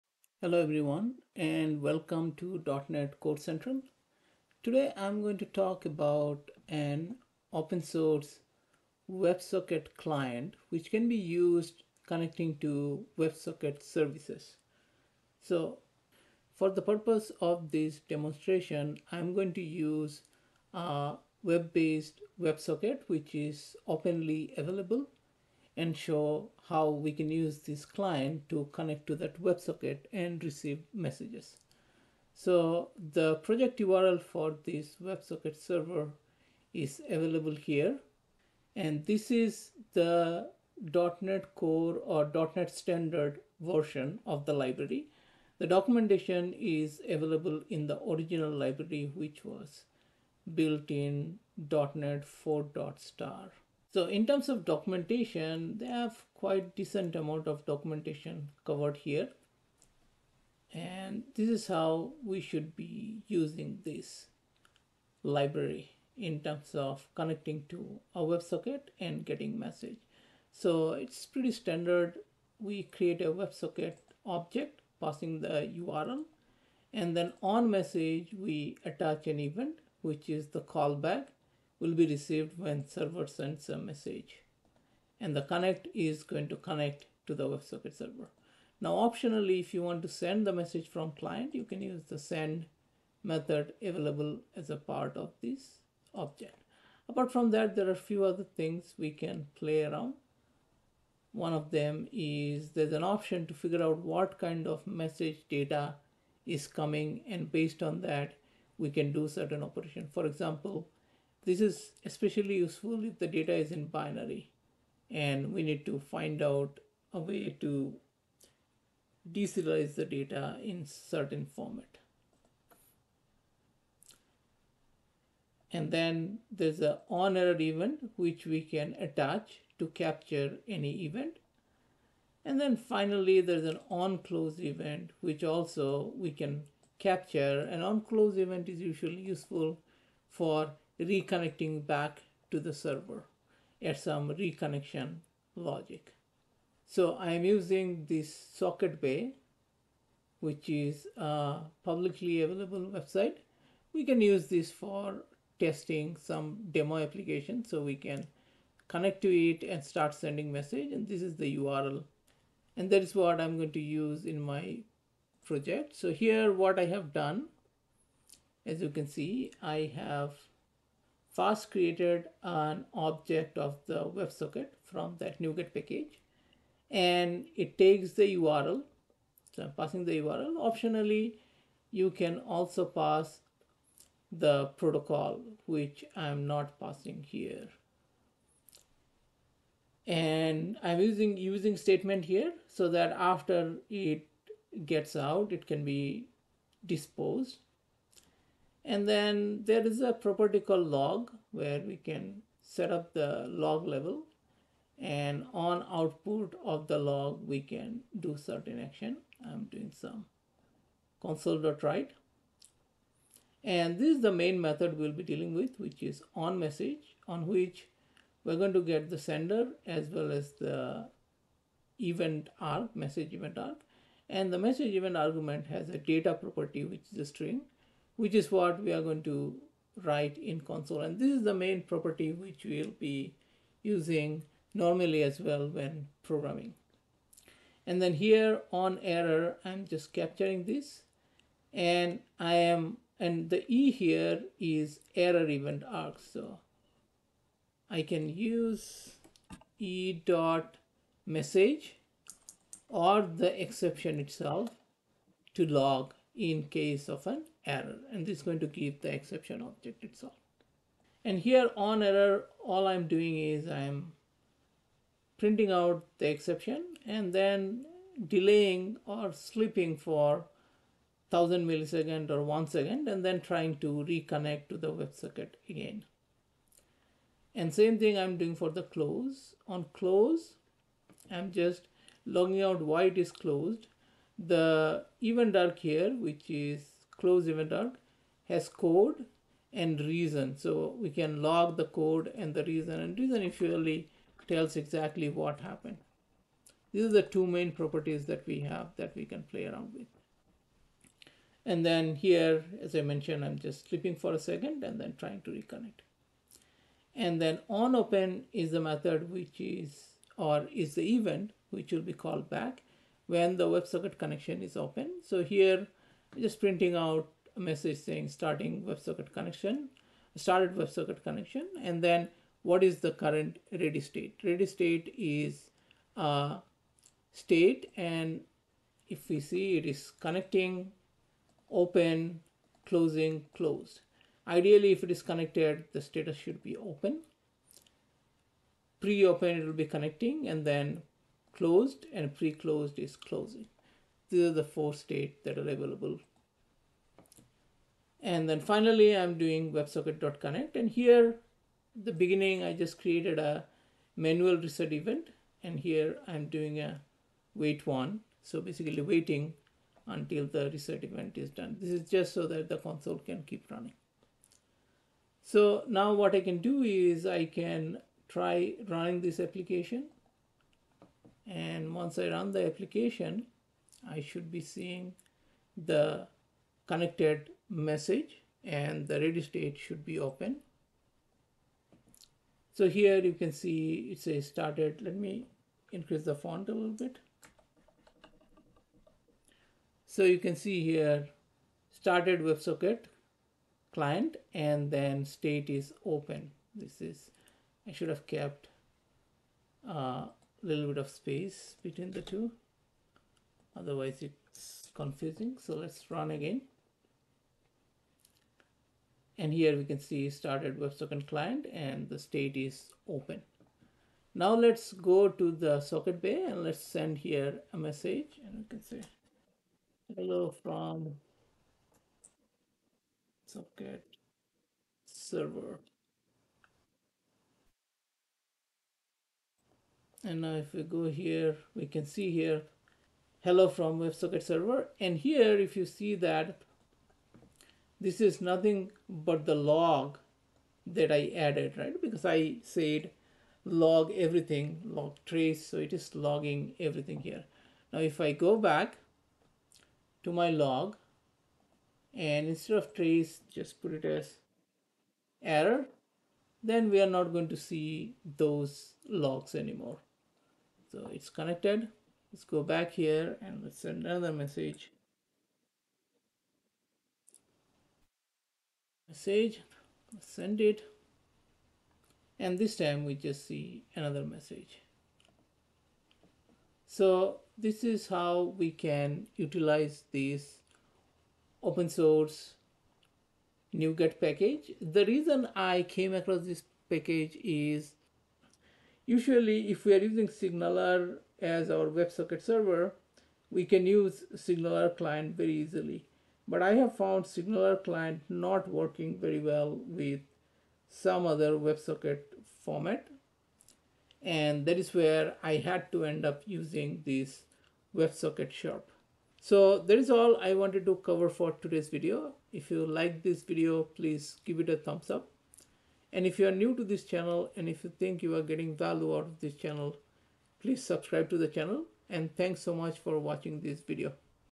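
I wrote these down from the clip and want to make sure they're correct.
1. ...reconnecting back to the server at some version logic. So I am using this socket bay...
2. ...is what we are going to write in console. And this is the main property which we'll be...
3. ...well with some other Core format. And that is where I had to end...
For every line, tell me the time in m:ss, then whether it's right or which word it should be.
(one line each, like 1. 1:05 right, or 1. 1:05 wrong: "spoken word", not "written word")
1. 2:21 wrong: "reconnection", not "version"
2. 3:48 right
3. 8:19 wrong: "WebSocket", not "Core".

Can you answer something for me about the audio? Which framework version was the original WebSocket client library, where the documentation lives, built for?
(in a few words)
.NET 4.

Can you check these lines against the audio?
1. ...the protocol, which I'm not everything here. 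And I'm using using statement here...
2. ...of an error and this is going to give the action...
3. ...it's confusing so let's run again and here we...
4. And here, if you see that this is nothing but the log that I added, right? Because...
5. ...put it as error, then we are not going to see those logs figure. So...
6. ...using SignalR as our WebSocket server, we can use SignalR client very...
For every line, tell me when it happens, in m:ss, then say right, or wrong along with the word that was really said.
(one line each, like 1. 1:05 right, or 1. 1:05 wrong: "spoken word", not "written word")
1. 3:04 wrong: "passing", not "everything"
2. 4:17 wrong: "exception", not "action"
3. 6:44 right
4. 7:14 right
5. 7:33 wrong: "anymore", not "figure"
6. 8:09 right.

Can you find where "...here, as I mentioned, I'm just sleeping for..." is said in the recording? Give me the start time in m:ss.
5:02.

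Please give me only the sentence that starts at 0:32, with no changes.
So the project URL for this WebSocket server is available here.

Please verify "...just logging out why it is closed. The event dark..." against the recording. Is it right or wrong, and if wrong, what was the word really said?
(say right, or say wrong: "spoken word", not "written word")
right.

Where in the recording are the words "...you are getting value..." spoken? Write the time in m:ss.
8:38.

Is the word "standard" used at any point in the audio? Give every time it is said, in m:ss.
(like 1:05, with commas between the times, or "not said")
0:42, 1:11.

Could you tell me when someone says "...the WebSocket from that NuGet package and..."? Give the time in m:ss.
2:53.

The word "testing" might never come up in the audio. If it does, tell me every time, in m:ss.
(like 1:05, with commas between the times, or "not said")
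2:35.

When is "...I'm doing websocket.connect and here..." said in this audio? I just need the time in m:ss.
5:49.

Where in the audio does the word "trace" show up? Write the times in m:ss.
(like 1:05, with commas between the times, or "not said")
7:25, 7:32.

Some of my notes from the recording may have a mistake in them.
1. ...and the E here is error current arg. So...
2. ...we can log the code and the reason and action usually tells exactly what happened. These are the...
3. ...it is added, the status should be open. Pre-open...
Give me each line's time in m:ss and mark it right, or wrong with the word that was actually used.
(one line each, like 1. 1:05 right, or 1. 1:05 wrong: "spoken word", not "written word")
1. 4:03 wrong: "event", not "current"
2. 4:51 wrong: "reason", not "action"
3. 5:35 wrong: "connected", not "added".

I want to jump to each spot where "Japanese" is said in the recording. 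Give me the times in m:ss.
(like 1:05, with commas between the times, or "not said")
not said.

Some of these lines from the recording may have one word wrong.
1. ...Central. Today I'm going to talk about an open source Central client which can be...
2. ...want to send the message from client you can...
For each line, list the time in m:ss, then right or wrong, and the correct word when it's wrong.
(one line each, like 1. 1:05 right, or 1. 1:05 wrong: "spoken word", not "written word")
1. 0:03 wrong: "WebSocket", not "Central"
2. 1:29 right.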